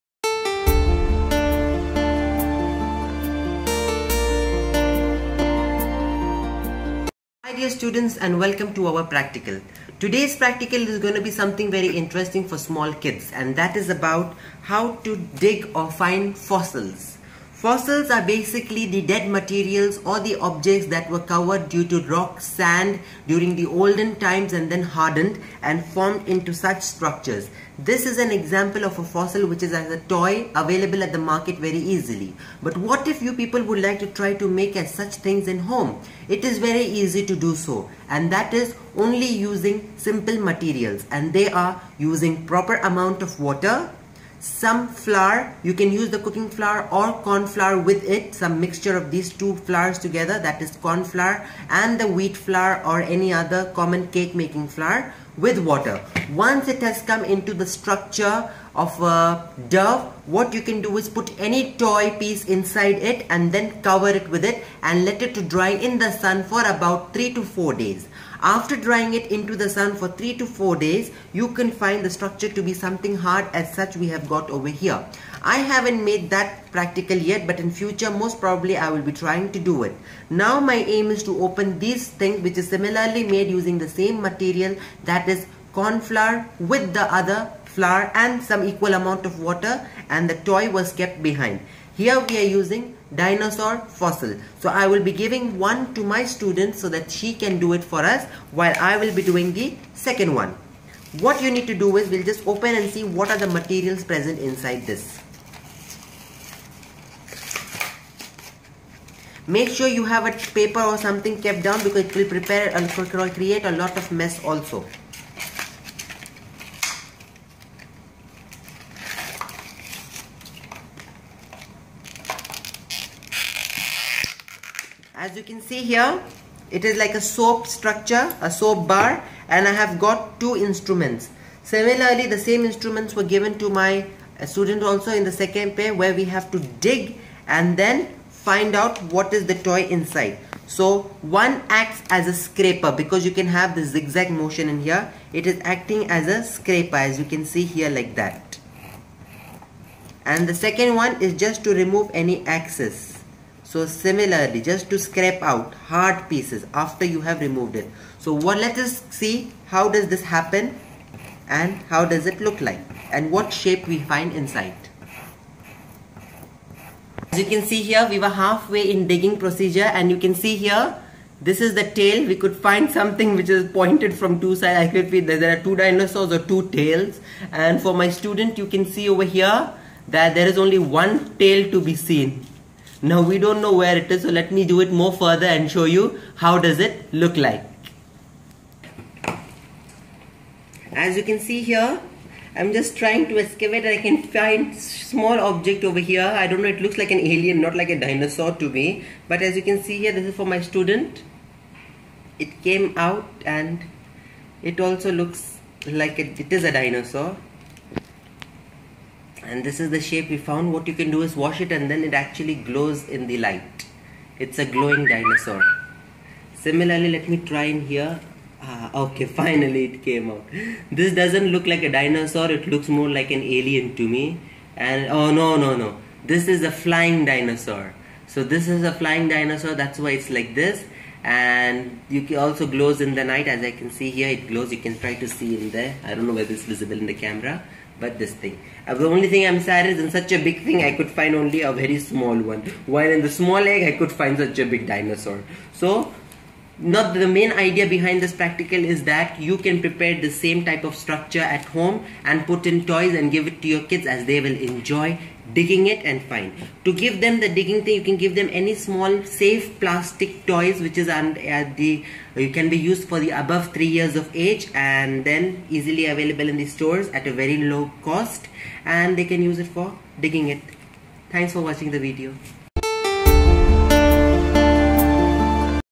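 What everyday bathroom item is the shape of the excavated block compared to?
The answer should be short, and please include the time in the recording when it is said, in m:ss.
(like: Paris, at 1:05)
A soap bar, at 2:08.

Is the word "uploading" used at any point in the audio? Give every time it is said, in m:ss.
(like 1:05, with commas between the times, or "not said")
not said.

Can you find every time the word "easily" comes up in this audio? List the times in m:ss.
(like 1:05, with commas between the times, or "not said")
0:31, 4:25.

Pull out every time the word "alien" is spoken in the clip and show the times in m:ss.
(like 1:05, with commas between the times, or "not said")
3:17, 3:43.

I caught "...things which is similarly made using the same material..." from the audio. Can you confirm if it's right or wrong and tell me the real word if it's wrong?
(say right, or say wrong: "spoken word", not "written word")
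right.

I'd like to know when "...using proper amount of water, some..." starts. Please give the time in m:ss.
0:41.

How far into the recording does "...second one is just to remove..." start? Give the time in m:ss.
2:30.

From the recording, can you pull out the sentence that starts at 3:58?
Uh, the only thing I'm sad is in such a big thing I could find only a very small one.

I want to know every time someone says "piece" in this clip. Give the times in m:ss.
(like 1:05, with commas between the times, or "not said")
1:02, 2:36.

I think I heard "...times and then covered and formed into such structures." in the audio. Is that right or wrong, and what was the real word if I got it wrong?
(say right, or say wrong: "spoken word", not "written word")
wrong: "hardened", not "covered".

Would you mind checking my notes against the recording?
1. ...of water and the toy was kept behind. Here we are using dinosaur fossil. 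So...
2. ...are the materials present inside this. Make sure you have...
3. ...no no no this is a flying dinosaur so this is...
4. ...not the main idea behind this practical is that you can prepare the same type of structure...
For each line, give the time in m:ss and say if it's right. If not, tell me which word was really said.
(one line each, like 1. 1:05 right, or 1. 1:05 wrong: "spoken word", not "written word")
1. 1:29 right
2. 1:43 right
3. 3:45 right
4. 4:06 right.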